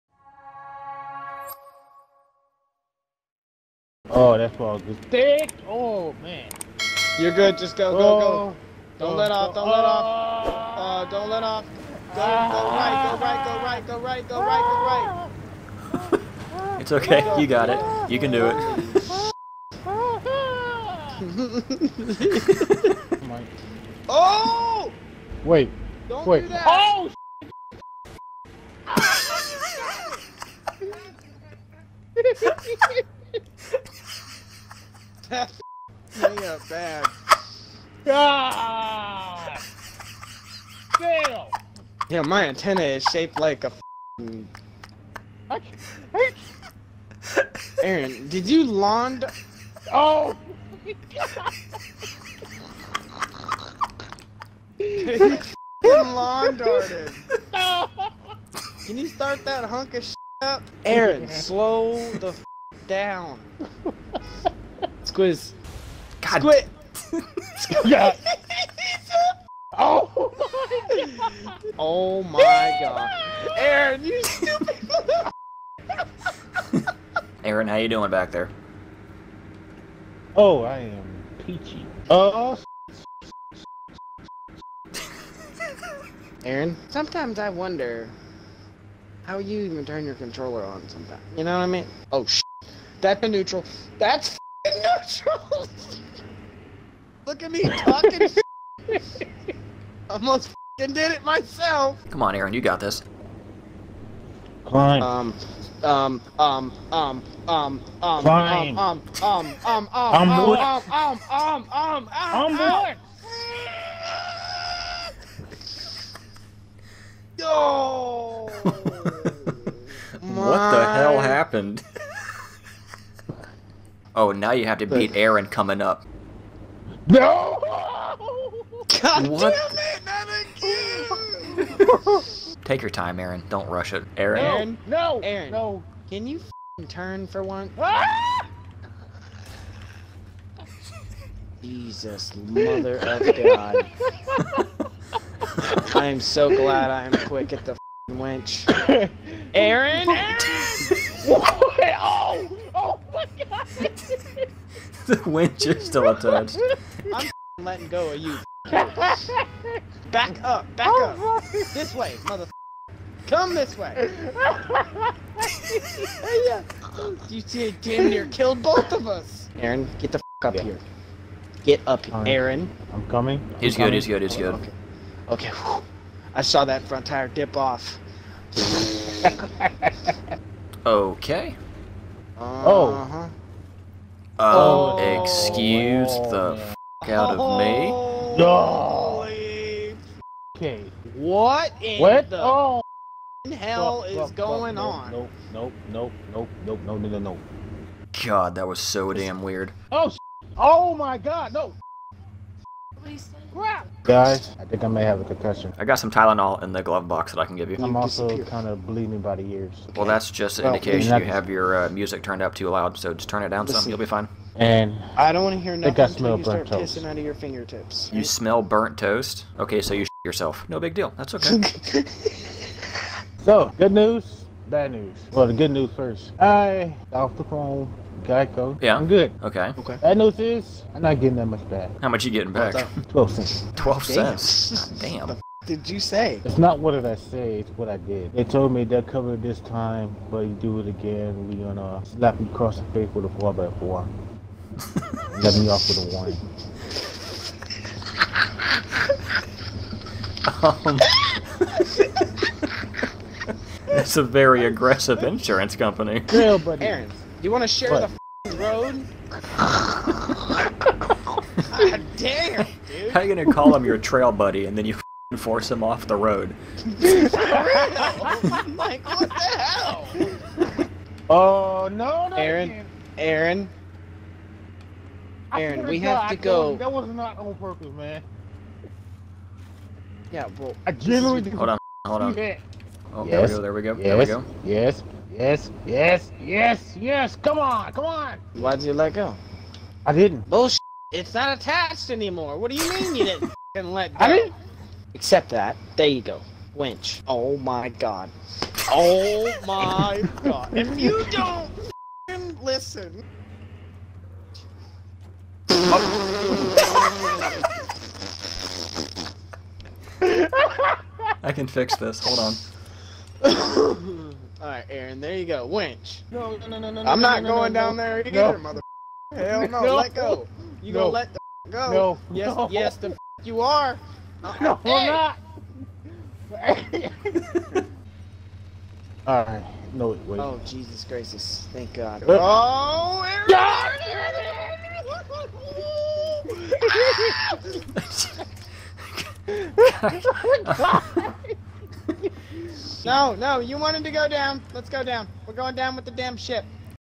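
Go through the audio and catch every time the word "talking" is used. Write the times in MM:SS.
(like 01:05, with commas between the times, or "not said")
01:37.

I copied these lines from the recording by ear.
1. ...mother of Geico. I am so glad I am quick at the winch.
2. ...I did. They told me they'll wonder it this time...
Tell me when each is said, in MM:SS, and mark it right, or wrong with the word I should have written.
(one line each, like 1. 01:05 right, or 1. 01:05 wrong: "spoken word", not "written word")
1. 02:22 wrong: "God", not "Geico"
2. 03:57 wrong: "cover", not "wonder".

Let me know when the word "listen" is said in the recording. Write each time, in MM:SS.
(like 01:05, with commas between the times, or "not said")
05:02.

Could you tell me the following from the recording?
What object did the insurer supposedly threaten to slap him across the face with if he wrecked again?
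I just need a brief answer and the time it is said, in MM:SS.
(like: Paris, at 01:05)
A four by four, at 04:03.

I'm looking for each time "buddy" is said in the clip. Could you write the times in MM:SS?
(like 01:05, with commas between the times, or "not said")
04:16, 04:24.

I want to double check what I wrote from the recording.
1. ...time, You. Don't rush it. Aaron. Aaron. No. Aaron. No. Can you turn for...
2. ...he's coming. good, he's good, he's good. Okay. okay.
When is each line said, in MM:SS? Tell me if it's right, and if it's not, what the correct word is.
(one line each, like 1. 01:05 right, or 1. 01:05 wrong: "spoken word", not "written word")
1. 02:12 wrong: "Aaron", not "You"
2. 02:53 right.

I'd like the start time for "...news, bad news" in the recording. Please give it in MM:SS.
03:43.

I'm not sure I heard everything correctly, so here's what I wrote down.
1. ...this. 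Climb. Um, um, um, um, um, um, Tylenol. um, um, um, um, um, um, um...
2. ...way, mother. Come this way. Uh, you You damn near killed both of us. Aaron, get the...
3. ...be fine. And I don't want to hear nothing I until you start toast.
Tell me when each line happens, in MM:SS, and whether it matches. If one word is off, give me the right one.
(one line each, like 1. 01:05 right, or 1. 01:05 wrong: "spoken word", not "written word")
1. 01:42 wrong: "Klein", not "Tylenol"
2. 02:41 right
3. 03:33 right.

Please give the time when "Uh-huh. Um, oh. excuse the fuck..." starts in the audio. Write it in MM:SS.
03:02.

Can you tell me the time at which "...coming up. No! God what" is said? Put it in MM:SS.
02:05.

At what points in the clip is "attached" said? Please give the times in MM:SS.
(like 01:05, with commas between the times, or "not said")
02:36, 04:51.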